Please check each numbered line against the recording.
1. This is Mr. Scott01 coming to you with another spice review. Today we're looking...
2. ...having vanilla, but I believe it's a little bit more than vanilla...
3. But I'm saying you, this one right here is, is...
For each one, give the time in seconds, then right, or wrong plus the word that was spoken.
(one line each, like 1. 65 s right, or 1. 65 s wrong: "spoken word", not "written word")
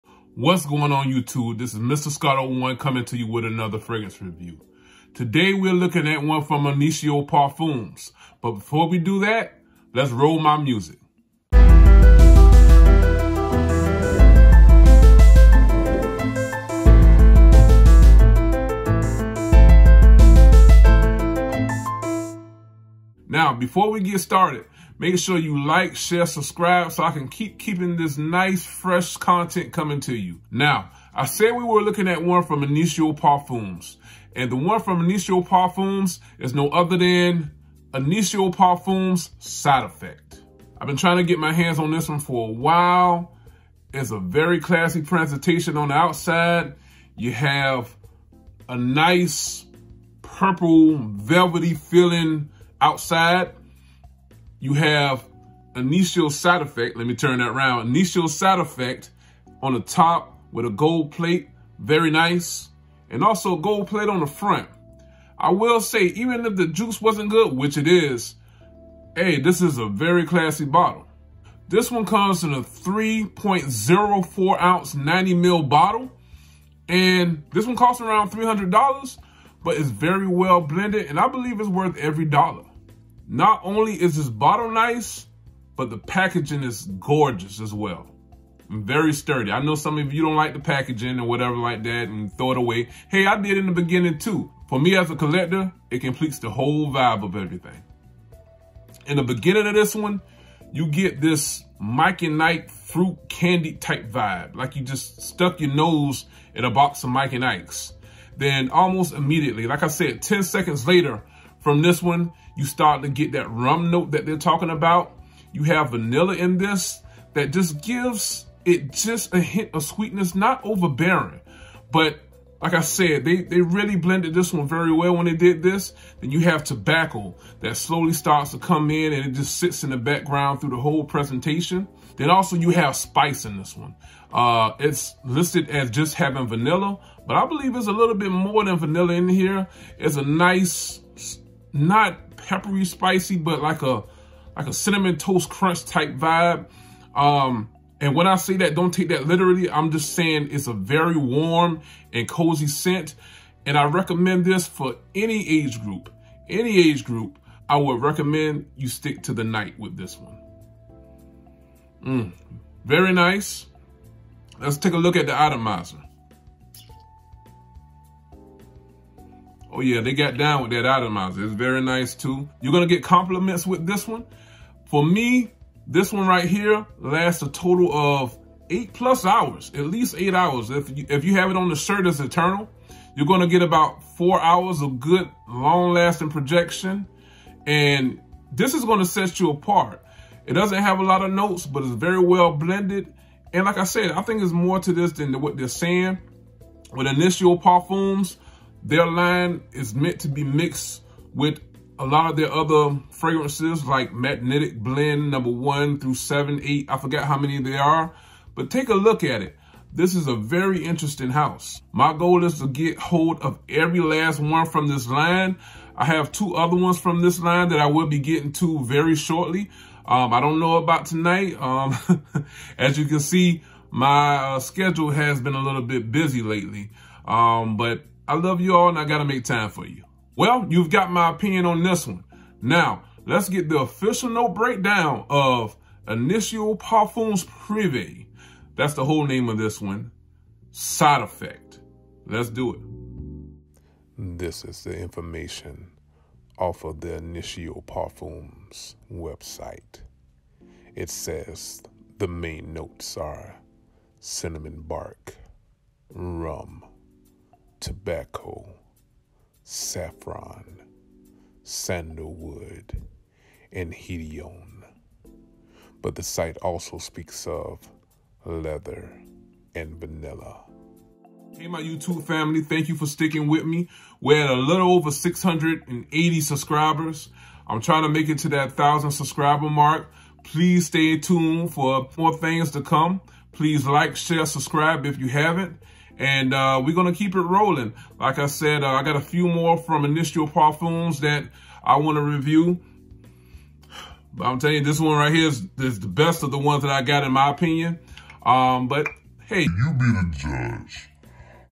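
1. 1 s wrong: "fragrance", not "spice"
2. 136 s right
3. 294 s wrong: "telling", not "saying".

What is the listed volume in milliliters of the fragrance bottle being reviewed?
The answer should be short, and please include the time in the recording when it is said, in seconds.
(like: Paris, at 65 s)
90 ml, at 74 s.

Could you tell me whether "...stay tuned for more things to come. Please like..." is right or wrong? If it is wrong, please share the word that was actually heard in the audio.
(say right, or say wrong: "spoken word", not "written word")
right.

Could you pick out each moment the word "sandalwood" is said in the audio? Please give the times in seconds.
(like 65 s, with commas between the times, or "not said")
261 s.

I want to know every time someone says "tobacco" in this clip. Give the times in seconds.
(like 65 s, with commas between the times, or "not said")
126 s, 257 s.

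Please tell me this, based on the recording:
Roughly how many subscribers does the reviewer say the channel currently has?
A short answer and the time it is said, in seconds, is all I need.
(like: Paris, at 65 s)
680, at 275 s.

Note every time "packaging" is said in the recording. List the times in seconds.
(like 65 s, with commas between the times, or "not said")
85 s, 90 s.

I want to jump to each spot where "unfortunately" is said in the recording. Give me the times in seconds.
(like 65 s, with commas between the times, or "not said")
not said.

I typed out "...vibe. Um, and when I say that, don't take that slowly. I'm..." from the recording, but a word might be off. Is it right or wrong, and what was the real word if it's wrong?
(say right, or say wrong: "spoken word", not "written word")
wrong: "literally", not "slowly".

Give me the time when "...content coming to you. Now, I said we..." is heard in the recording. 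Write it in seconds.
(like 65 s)
29 s.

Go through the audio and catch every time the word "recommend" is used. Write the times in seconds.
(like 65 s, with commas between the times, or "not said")
153 s, 158 s.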